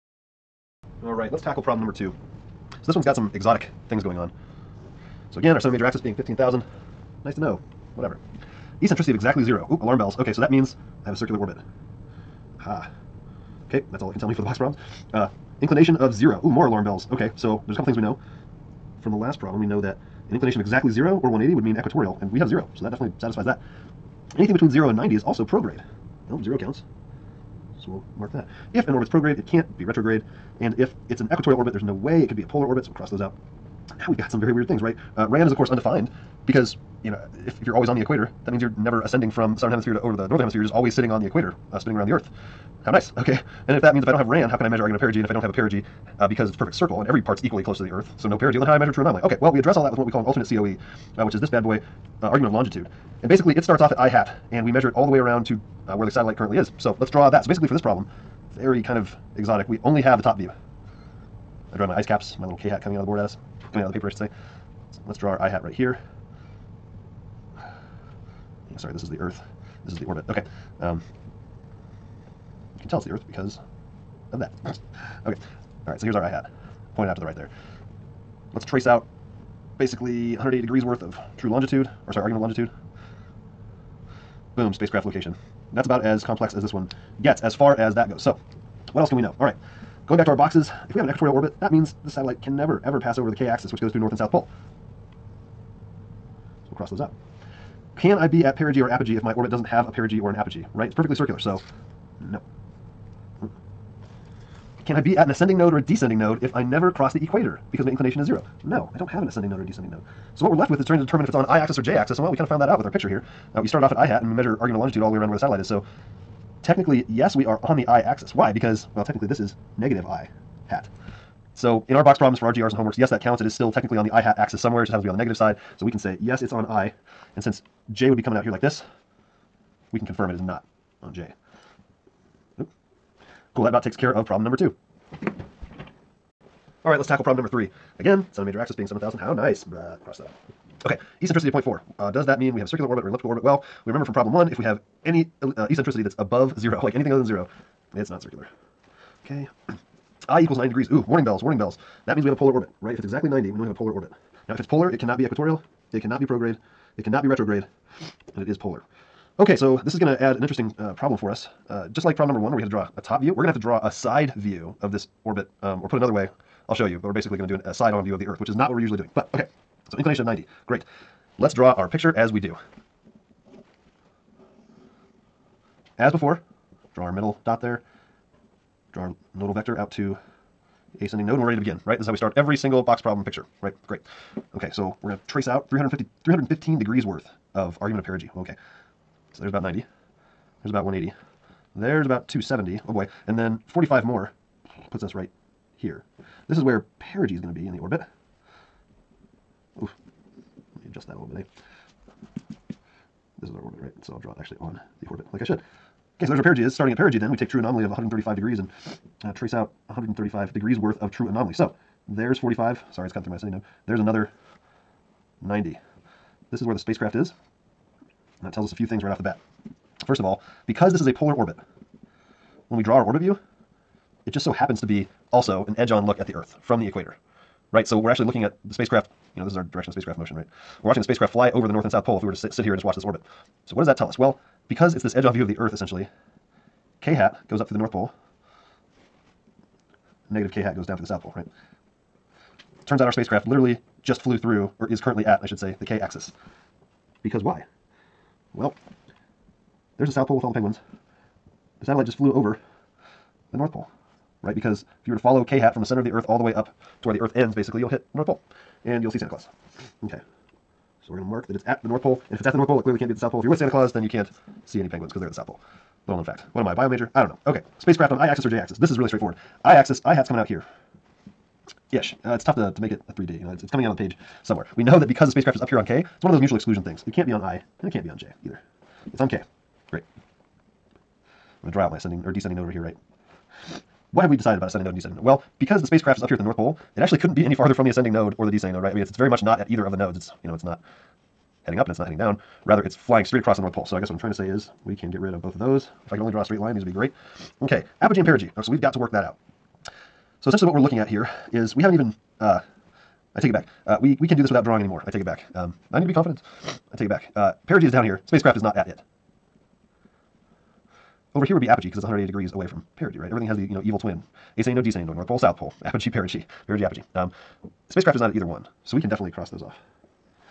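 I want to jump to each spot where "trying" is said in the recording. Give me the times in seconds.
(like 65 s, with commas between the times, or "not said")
110 s, 294 s.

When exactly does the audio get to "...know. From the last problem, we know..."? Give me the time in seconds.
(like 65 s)
18 s.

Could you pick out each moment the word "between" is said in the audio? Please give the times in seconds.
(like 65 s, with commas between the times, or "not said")
24 s.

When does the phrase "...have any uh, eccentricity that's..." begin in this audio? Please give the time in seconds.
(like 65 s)
144 s.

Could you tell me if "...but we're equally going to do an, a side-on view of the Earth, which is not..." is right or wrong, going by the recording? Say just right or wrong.
wrong.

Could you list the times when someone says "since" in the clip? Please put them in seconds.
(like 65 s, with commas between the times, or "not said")
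127 s.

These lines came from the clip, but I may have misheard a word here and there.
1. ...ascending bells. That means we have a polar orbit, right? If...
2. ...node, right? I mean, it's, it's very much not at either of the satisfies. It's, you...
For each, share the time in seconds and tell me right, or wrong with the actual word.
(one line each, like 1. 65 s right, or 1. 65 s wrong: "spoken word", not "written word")
1. 151 s wrong: "warning", not "ascending"
2. 288 s wrong: "nodes", not "satisfies".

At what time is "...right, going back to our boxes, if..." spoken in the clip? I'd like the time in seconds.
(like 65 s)
89 s.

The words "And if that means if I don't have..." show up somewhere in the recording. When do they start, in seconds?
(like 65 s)
43 s.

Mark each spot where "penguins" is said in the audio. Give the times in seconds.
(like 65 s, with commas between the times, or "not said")
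250 s, 264 s.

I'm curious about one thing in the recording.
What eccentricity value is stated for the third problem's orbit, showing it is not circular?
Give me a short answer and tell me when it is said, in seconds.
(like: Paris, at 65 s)
0.4, at 141 s.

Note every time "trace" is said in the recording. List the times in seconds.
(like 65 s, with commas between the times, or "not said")
78 s, 185 s, 209 s.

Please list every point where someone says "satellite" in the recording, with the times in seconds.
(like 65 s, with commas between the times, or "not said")
56 s, 92 s, 115 s, 251 s.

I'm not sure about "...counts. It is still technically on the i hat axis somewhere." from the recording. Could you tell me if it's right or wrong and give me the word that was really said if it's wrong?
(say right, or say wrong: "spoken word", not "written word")
right.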